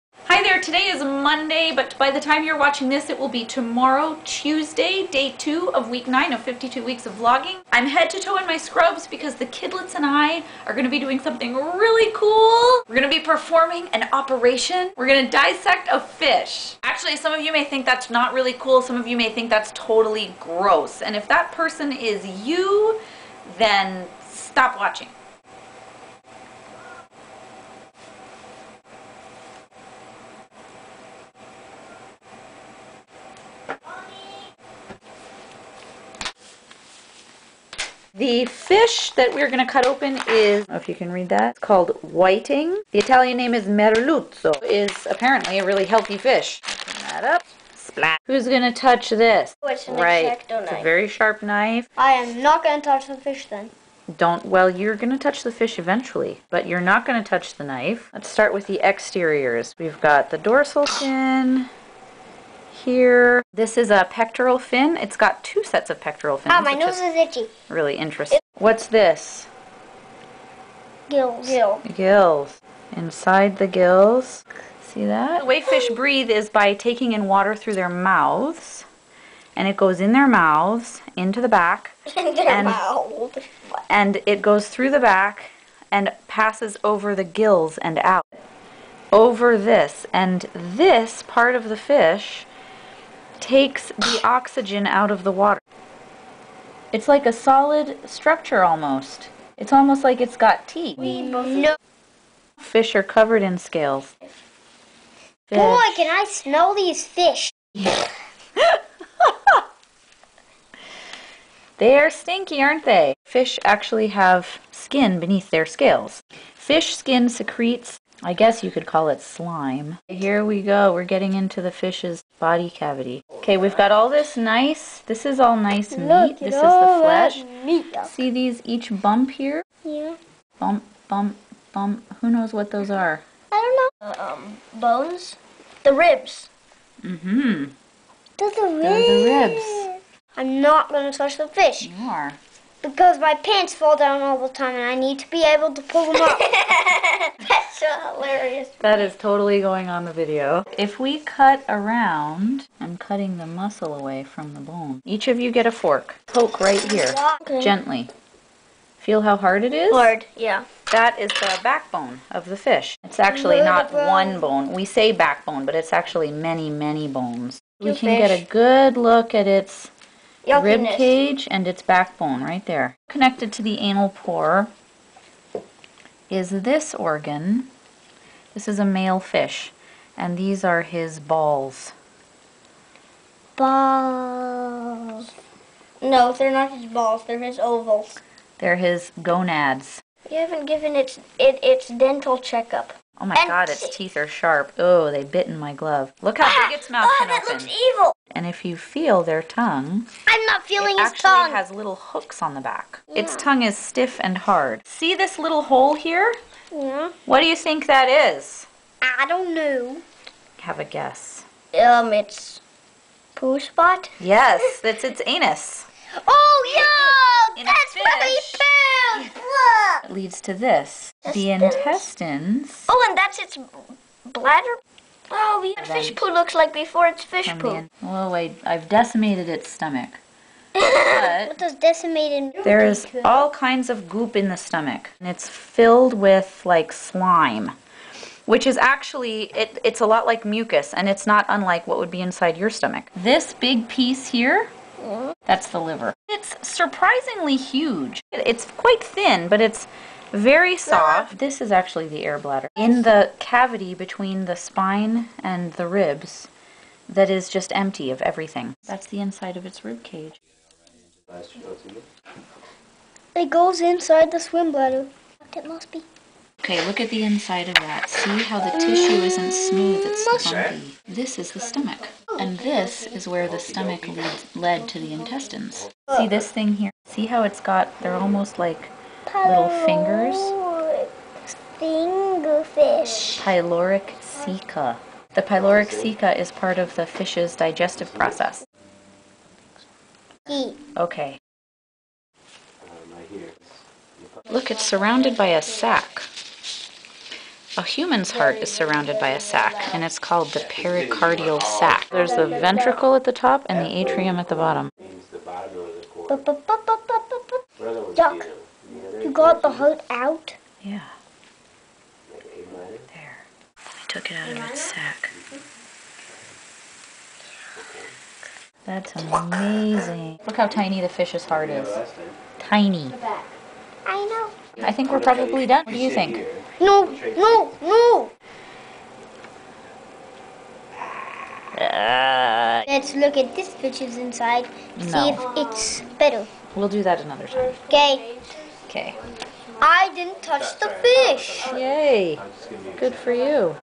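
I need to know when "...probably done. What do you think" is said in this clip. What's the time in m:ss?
5:25.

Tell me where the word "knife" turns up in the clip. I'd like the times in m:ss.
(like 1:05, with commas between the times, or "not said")
0:51, 0:57.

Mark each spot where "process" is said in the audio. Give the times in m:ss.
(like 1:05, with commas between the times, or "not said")
4:48.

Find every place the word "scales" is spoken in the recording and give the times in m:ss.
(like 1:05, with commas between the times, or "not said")
1:43, 1:55.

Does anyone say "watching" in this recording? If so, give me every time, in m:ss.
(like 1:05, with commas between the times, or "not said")
0:02, 0:24.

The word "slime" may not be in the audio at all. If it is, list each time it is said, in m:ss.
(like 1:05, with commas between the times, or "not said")
1:59, 3:56.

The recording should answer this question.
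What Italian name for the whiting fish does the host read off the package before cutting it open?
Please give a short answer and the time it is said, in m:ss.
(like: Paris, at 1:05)
merluzzo, at 0:43.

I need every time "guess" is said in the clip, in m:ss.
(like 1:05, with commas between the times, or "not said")
1:58, 3:30.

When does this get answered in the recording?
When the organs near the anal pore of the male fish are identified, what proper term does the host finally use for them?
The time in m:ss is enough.
3:09.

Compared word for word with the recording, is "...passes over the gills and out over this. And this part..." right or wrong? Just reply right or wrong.
right.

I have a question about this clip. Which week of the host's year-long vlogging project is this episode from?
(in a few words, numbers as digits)
9.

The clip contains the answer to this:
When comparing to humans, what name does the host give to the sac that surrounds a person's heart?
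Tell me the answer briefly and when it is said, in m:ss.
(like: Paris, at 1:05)
pericardial sac, at 5:00.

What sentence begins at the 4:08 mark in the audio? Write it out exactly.
It's quite thin, but it's very soft.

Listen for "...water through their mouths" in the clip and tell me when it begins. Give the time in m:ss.
1:17.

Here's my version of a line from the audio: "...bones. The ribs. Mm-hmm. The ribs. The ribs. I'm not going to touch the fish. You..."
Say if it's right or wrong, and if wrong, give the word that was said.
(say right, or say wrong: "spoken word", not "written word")
right.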